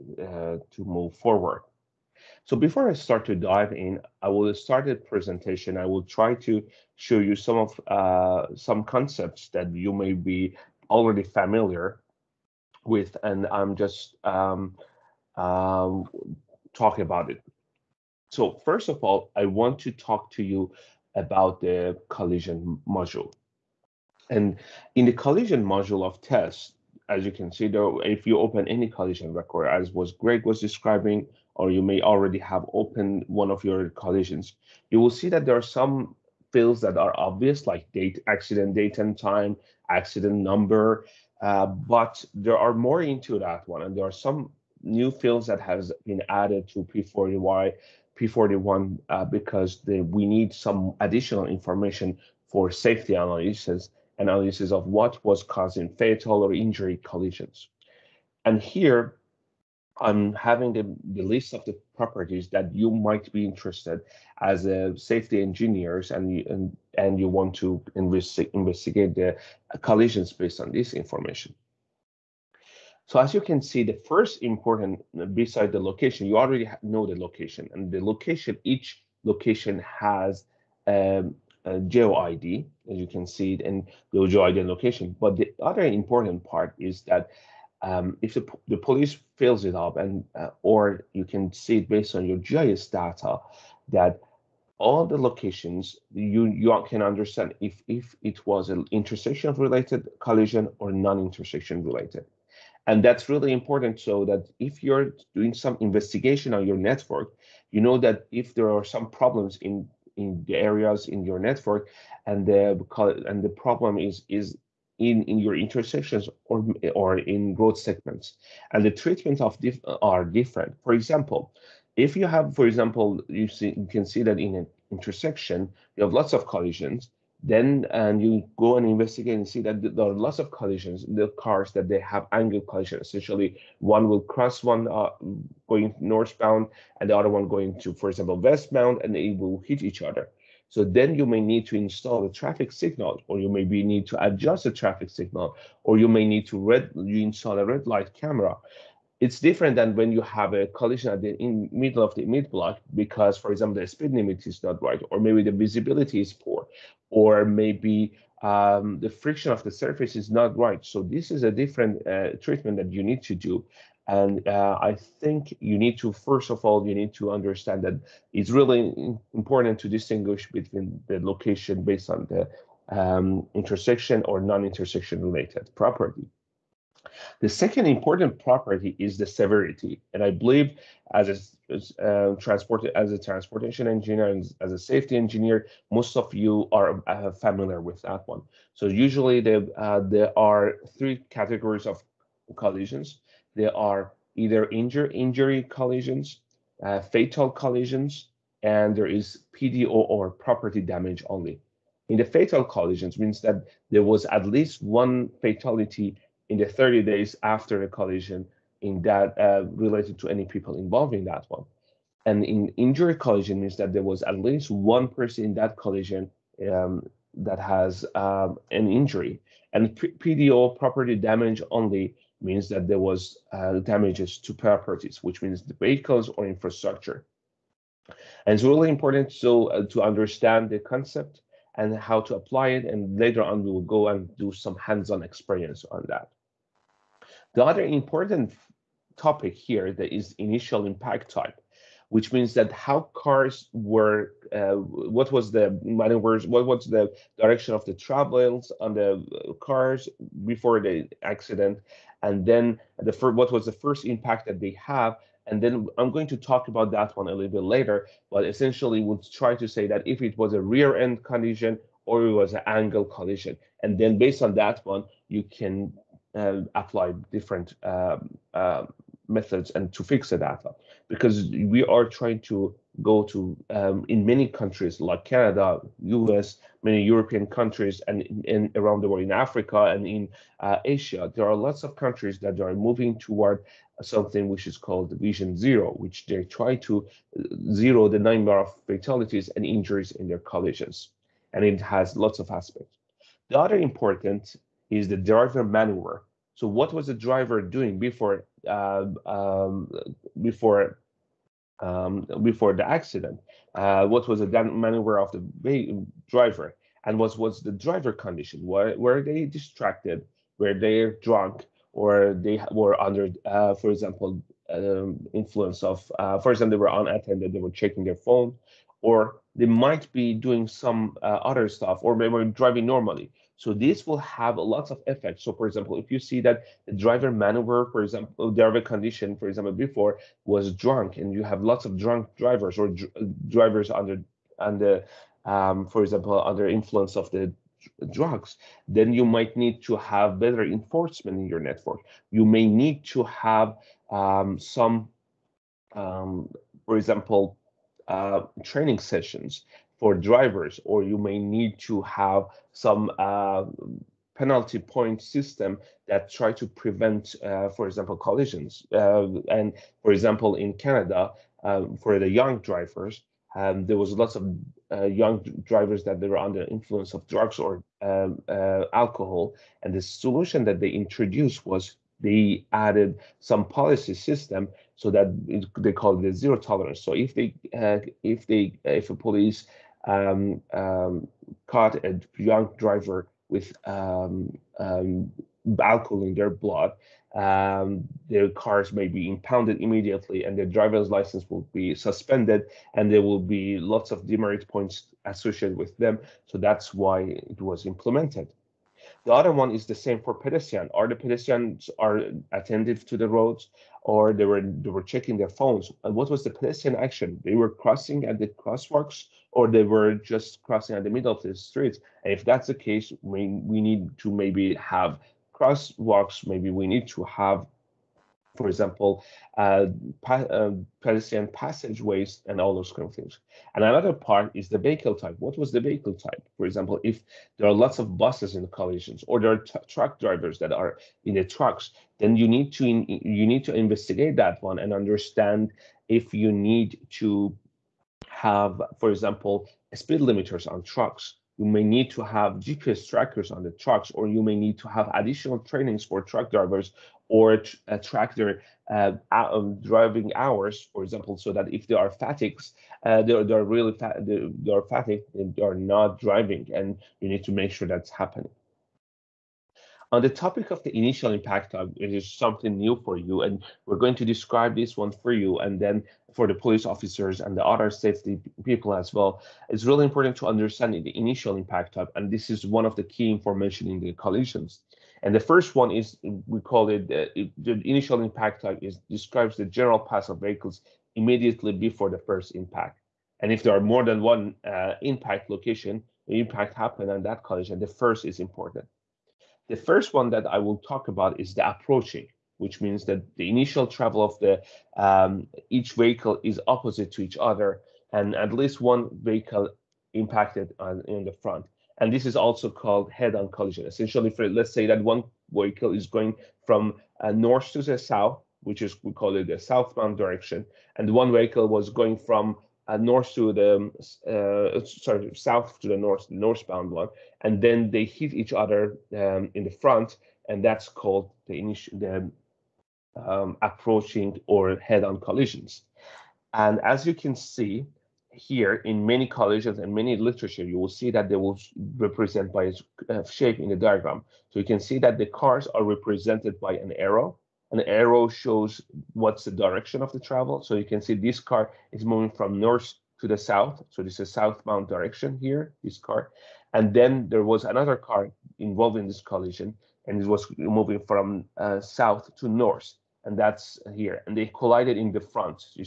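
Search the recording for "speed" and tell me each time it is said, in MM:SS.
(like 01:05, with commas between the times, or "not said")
02:33, 07:19.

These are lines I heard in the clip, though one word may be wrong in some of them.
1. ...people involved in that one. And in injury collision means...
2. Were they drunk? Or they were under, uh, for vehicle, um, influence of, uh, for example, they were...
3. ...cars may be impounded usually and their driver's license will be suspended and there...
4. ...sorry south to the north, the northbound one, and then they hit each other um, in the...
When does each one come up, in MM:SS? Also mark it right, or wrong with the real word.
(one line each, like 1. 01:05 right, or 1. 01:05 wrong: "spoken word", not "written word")
1. 03:30 right
2. 05:10 wrong: "example", not "vehicle"
3. 06:28 wrong: "immediately", not "usually"
4. 08:34 right.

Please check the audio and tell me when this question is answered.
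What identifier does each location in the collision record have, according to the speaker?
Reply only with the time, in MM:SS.
01:24.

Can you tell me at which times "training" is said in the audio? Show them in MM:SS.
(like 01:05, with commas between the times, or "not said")
05:48, 07:25.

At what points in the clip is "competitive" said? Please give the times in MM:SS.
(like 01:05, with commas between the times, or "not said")
not said.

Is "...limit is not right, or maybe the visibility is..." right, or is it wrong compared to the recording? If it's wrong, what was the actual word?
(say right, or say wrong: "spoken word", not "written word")
right.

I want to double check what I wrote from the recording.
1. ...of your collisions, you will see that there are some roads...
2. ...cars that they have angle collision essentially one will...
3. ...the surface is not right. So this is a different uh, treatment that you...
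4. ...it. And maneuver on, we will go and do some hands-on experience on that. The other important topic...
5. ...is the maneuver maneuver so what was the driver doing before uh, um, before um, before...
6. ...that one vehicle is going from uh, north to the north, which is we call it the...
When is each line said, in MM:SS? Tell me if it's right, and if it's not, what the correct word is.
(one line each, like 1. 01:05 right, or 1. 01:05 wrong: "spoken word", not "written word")
1. 00:33 wrong: "fields", not "roads"
2. 02:11 right
3. 02:39 right
4. 03:52 wrong: "later", not "maneuver"
5. 04:54 wrong: "driver", not "maneuver"
6. 08:24 wrong: "south", not "north".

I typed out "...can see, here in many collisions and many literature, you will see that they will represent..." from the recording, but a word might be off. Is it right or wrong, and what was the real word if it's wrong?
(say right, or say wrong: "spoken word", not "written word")
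right.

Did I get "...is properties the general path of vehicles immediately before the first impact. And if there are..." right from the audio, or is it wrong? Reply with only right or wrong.
wrong.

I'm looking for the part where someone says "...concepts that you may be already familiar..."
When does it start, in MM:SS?
00:08.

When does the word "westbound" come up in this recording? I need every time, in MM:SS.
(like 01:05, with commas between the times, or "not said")
02:18.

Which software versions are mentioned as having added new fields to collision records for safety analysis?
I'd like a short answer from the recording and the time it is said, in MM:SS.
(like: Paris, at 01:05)
P40Y, P41, at 00:46.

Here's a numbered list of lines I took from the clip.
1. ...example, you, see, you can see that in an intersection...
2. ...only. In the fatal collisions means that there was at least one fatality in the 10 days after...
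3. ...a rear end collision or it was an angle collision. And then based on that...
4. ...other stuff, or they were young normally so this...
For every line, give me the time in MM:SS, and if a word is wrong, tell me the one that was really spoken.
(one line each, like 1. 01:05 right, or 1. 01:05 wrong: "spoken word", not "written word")
1. 02:02 right
2. 03:21 wrong: "30", not "10"
3. 04:20 right
4. 05:21 wrong: "driving", not "young".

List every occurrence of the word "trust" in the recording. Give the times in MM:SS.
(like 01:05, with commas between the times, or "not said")
not said.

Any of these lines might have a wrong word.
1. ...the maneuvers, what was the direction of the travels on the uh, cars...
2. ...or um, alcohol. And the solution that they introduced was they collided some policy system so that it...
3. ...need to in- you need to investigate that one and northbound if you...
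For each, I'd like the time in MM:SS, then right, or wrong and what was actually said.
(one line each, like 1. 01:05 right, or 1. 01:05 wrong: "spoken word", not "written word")
1. 04:05 right
2. 06:07 wrong: "added", not "collided"
3. 07:12 wrong: "understand", not "northbound".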